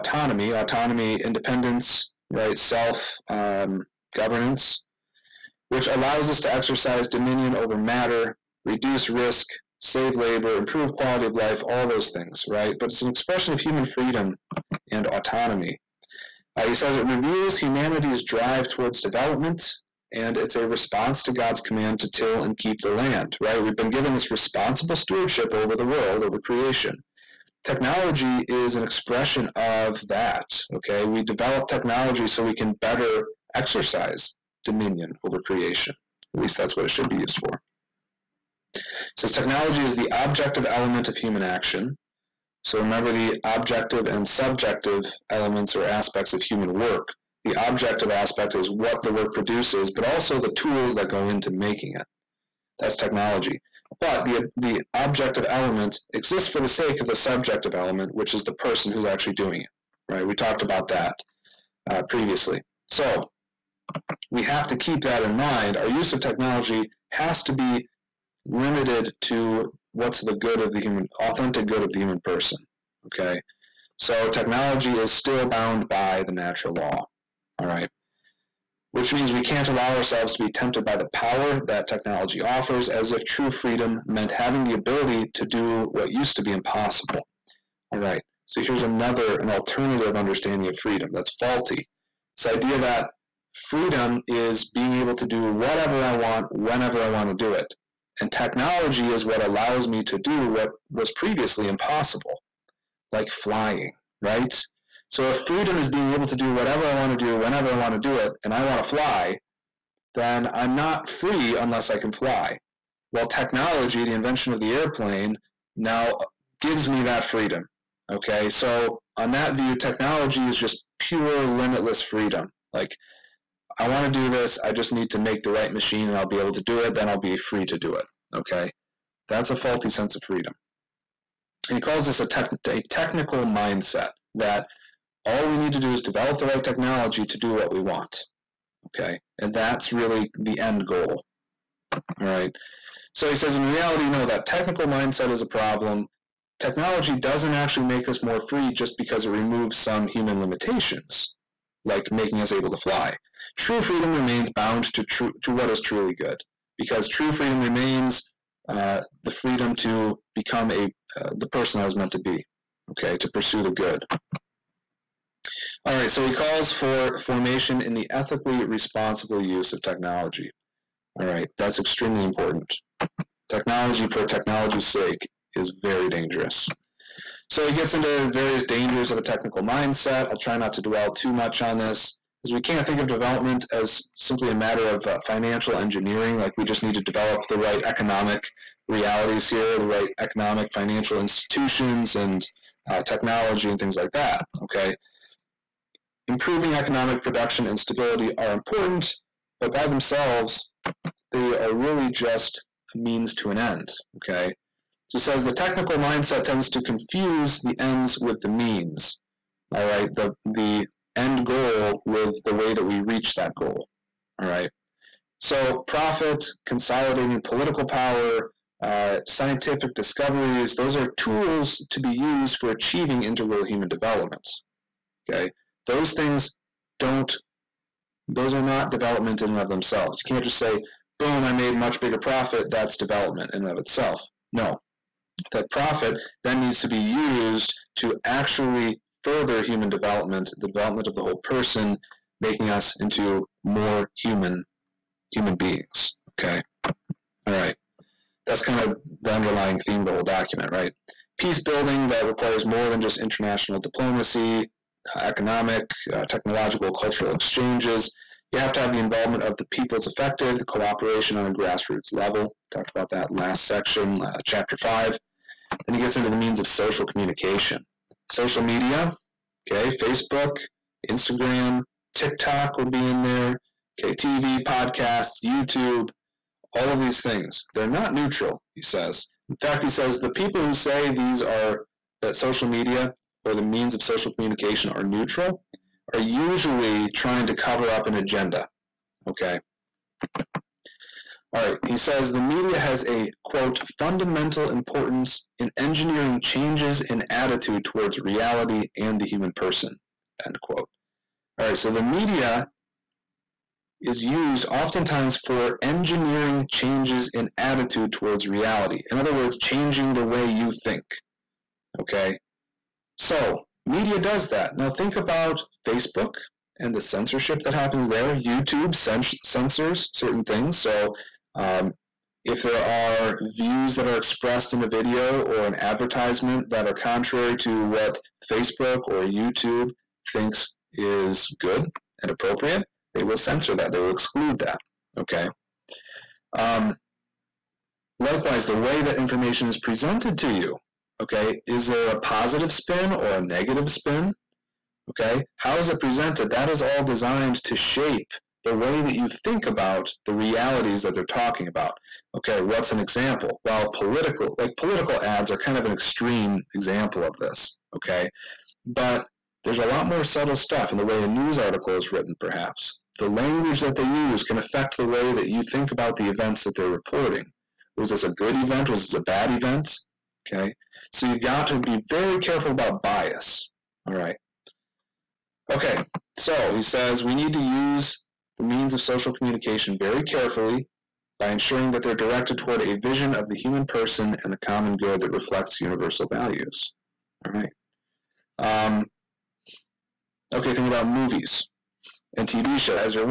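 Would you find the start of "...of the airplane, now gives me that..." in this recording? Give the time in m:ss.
1:54.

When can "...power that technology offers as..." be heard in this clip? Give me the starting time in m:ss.
1:21.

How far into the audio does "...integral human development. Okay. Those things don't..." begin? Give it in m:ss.
3:43.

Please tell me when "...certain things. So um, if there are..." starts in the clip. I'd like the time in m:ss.
5:20.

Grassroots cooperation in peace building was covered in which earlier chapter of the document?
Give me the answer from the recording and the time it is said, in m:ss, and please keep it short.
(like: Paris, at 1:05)
chapter five, at 4:24.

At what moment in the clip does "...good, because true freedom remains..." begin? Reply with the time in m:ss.
2:36.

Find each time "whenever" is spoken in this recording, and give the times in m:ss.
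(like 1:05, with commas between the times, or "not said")
1:36, 1:47.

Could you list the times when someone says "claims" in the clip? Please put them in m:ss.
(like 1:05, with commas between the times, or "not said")
not said.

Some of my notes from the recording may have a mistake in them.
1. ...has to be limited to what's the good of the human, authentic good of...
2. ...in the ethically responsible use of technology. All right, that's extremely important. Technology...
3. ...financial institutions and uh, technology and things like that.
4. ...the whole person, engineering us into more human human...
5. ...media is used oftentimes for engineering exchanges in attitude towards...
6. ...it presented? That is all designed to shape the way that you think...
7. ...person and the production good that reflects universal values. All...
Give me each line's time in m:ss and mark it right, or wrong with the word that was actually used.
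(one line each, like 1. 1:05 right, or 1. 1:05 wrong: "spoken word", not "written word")
1. 1:07 right
2. 2:47 right
3. 3:10 right
4. 4:01 wrong: "making", not "engineering"
5. 5:02 wrong: "changes", not "exchanges"
6. 5:45 right
7. 6:23 wrong: "common", not "production".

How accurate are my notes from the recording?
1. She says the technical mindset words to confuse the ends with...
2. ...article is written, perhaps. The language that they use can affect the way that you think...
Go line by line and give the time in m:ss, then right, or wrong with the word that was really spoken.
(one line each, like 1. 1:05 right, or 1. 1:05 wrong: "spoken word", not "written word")
1. 3:25 wrong: "tends", not "words"
2. 6:01 right.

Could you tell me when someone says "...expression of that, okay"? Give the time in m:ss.
0:28.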